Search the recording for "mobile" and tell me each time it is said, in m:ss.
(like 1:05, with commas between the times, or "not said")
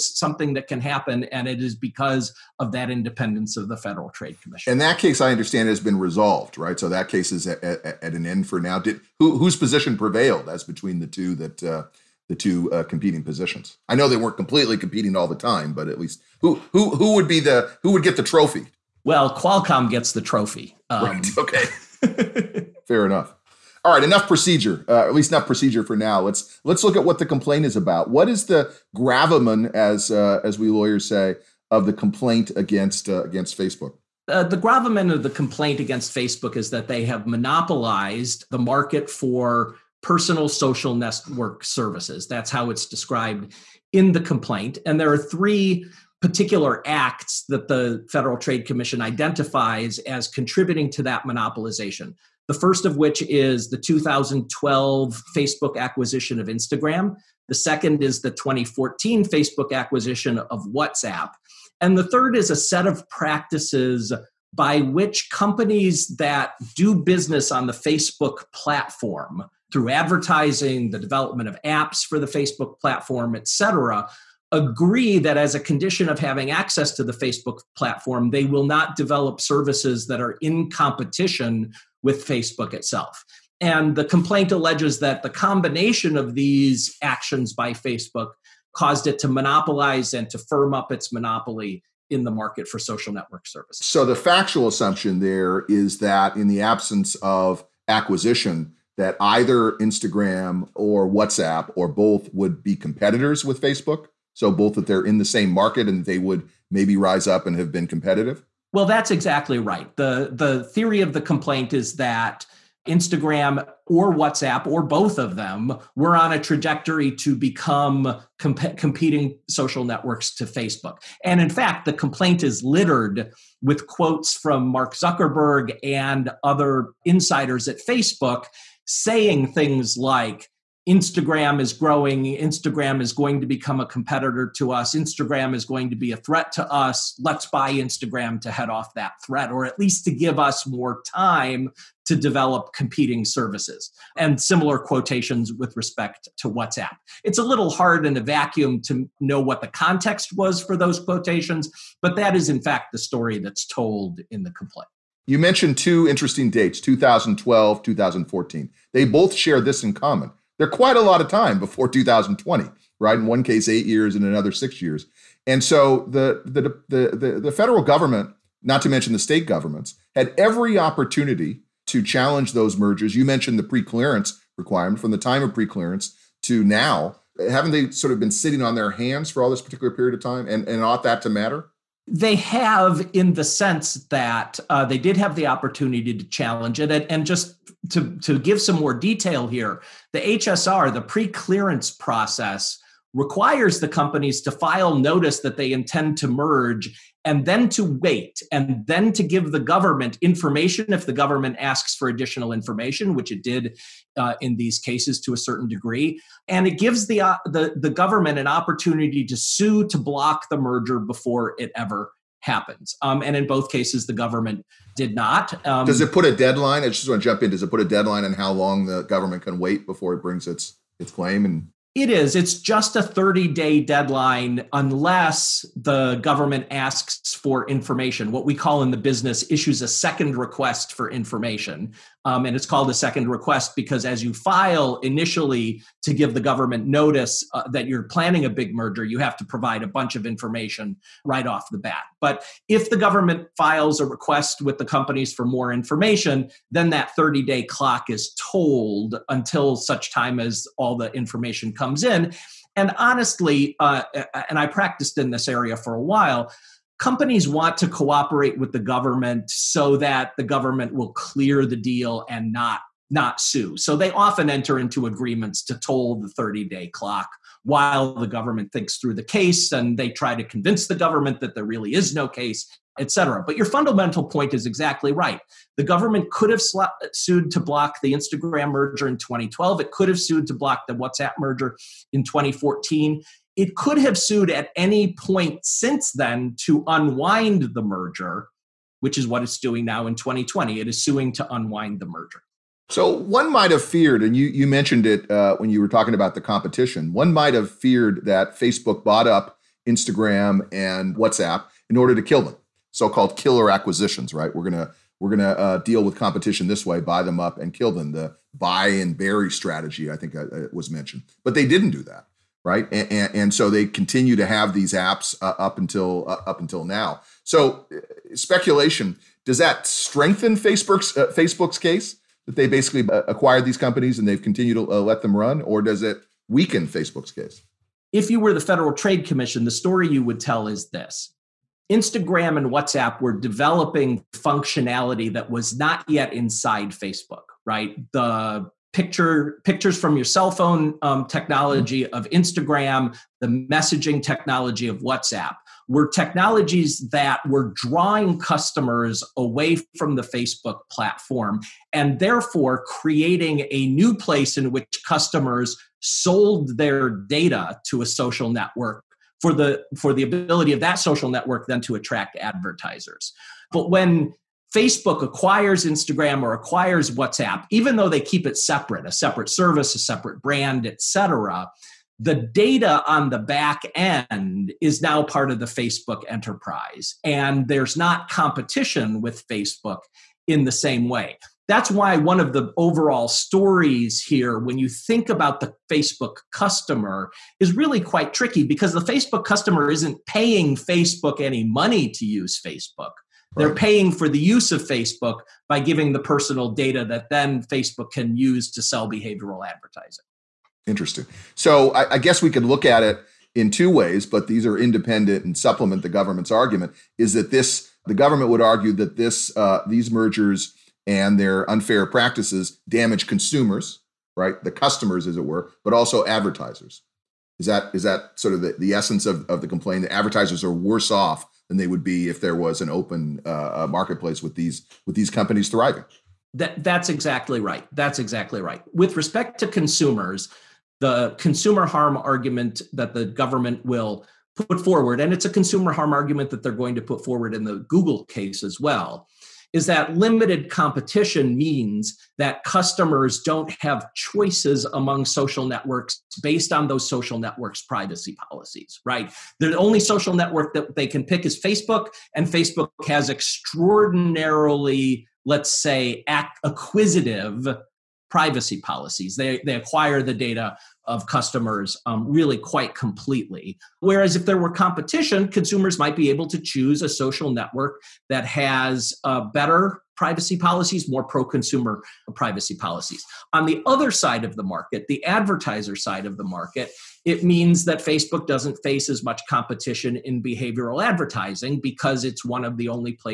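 not said.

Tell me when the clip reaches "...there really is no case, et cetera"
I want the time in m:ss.
4:31.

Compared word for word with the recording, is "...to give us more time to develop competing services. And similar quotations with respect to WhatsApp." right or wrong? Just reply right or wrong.
right.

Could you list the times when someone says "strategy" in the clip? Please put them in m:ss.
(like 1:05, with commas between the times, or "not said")
5:09.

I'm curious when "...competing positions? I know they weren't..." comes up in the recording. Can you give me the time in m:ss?
0:12.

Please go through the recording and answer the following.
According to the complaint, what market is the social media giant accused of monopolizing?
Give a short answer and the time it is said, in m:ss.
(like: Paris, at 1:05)
personal social network services, at 0:40.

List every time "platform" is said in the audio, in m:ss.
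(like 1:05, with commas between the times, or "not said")
1:08, 1:12, 1:17, 5:50.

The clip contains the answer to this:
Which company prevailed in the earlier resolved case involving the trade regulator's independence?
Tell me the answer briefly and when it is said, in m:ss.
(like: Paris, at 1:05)
Qualcomm, at 0:19.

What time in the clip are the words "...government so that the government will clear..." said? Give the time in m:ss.
4:18.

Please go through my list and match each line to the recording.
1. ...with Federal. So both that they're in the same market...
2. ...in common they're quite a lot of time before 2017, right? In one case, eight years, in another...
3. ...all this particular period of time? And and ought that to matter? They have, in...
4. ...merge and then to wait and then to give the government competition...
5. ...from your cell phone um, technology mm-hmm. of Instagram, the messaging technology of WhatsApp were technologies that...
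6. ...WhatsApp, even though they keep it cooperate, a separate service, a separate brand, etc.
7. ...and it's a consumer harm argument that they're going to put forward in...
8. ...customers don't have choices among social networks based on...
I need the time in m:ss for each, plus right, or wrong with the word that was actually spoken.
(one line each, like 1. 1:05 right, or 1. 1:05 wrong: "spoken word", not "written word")
1. 1:43 wrong: "Facebook", not "Federal"
2. 2:39 wrong: "2020", not "2017"
3. 2:59 right
4. 3:16 wrong: "information", not "competition"
5. 5:39 right
6. 6:07 wrong: "separate", not "cooperate"
7. 7:15 right
8. 7:22 right.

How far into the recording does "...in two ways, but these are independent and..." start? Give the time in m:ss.
6:43.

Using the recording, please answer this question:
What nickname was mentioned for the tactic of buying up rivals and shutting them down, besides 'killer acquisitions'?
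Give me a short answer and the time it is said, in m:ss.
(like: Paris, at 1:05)
buy and bury, at 5:08.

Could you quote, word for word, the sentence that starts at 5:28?
If you were the Federal Trade Commission, the story you would tell is this.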